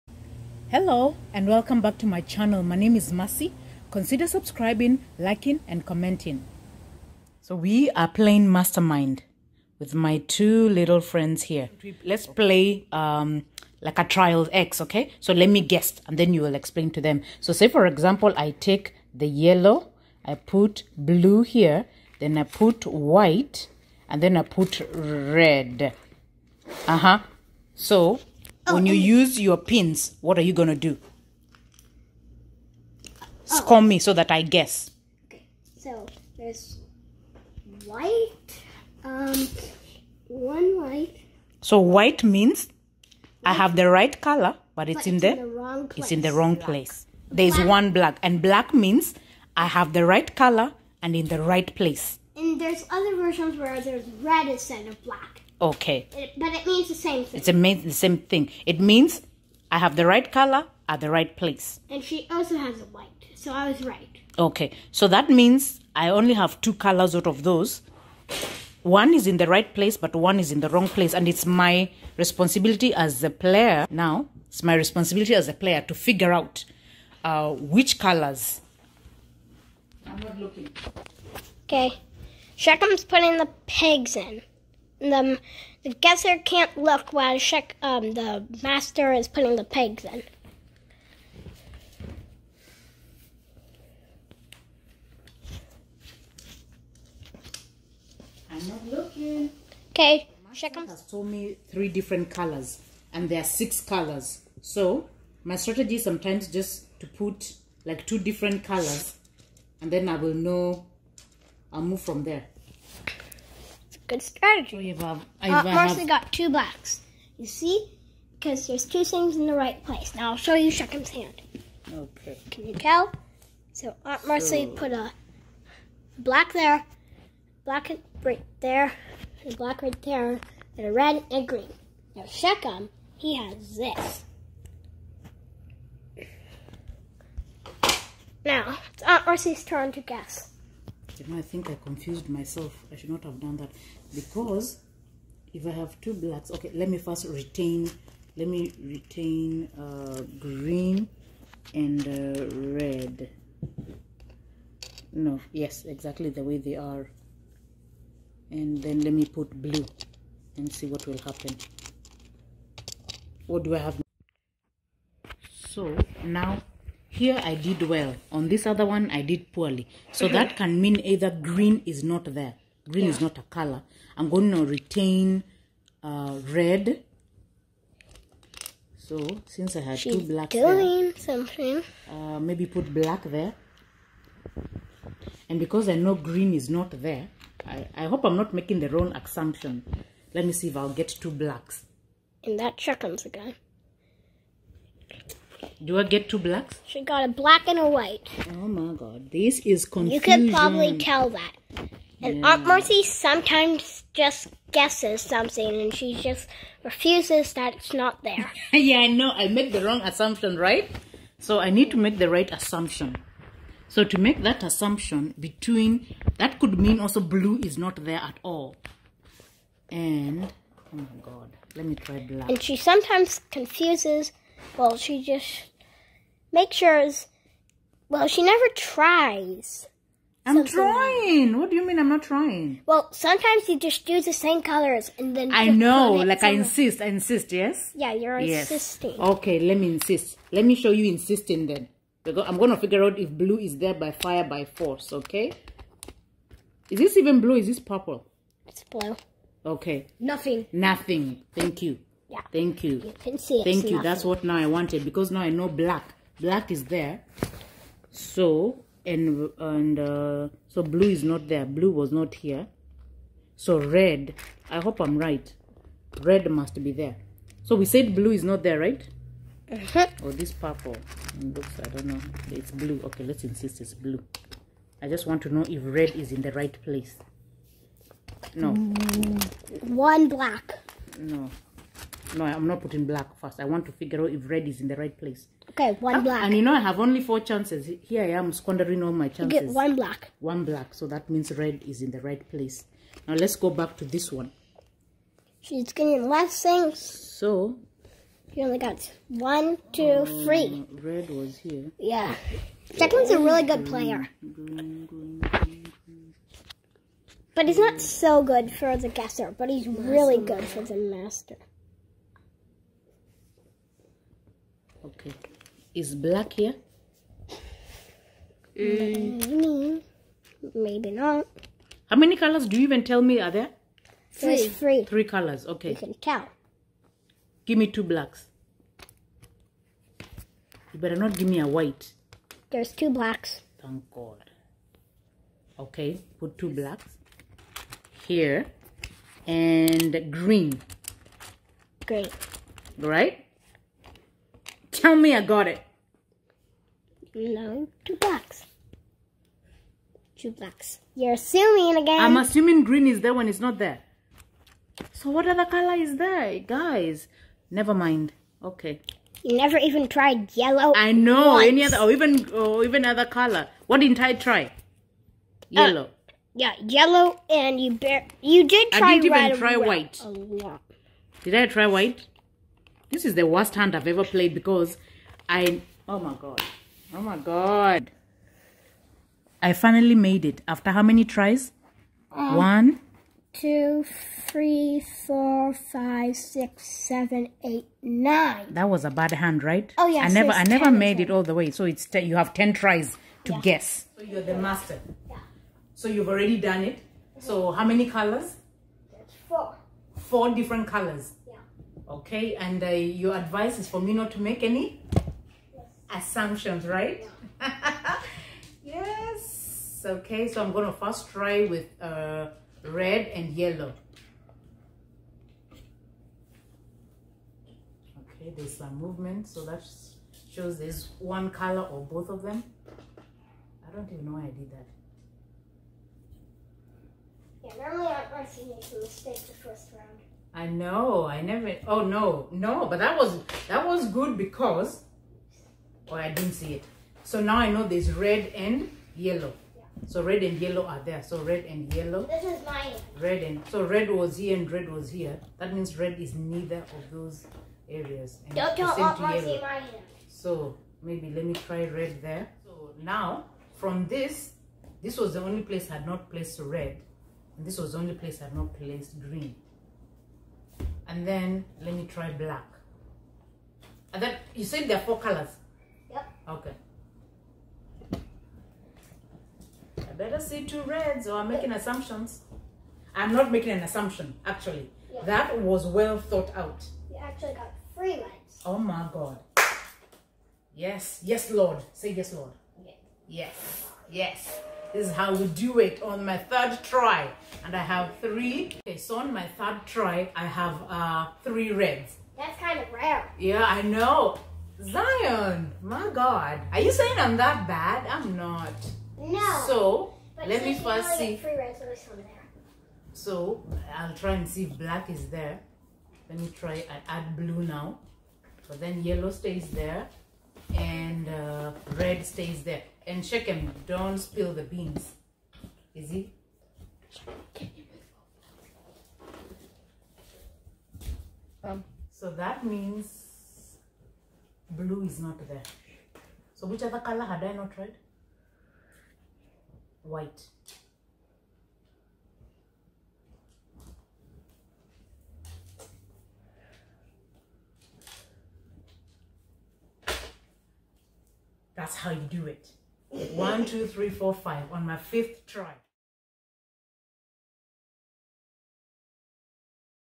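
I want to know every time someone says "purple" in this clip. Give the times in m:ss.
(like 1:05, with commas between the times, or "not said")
4:07, 4:30.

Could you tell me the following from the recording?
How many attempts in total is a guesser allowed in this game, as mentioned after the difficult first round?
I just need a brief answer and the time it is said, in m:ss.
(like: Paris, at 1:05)
10, at 6:32.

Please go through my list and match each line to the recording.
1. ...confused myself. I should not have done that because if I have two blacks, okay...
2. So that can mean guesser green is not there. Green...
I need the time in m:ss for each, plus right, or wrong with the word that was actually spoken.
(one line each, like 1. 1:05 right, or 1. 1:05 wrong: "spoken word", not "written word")
1. 2:21 right
2. 2:50 wrong: "either", not "guesser".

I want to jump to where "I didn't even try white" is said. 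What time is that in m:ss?
6:09.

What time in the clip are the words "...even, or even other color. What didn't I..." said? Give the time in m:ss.
6:02.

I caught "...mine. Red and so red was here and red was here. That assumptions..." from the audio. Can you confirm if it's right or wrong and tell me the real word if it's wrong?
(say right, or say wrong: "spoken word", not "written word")
wrong: "means", not "assumptions".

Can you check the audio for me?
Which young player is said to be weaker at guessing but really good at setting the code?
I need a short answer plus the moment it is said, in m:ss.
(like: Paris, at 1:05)
Declan, at 5:02.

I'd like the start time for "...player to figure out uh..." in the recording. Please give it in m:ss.
1:15.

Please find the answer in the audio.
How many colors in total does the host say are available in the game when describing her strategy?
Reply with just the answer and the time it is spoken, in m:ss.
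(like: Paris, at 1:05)
6, at 1:43.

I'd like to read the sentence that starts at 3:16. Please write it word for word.
She got a black and a white.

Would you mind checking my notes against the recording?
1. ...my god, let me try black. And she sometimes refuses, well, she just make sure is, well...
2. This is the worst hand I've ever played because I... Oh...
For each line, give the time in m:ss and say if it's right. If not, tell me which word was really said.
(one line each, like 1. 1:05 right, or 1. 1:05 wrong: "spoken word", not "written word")
1. 3:40 wrong: "confuses", not "refuses"
2. 6:13 right.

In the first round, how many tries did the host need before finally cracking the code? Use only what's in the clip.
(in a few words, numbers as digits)
9.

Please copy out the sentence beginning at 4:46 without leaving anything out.
And you know, I have only four chances.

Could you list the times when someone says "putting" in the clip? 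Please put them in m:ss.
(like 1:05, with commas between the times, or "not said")
1:23, 1:29, 4:42.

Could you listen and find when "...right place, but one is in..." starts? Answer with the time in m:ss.
1:09.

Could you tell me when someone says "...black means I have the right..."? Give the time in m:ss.
0:48.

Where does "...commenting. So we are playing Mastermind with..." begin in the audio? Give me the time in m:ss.
0:05.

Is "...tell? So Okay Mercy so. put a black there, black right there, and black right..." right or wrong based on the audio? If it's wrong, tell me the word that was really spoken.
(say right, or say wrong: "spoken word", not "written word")
wrong: "Aunt", not "Okay".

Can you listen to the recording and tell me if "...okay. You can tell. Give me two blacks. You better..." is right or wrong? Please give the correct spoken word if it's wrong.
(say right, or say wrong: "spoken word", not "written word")
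right.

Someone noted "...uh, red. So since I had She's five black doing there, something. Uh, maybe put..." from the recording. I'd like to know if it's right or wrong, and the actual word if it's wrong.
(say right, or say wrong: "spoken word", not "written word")
wrong: "two", not "five".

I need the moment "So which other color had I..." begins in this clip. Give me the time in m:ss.
8:46.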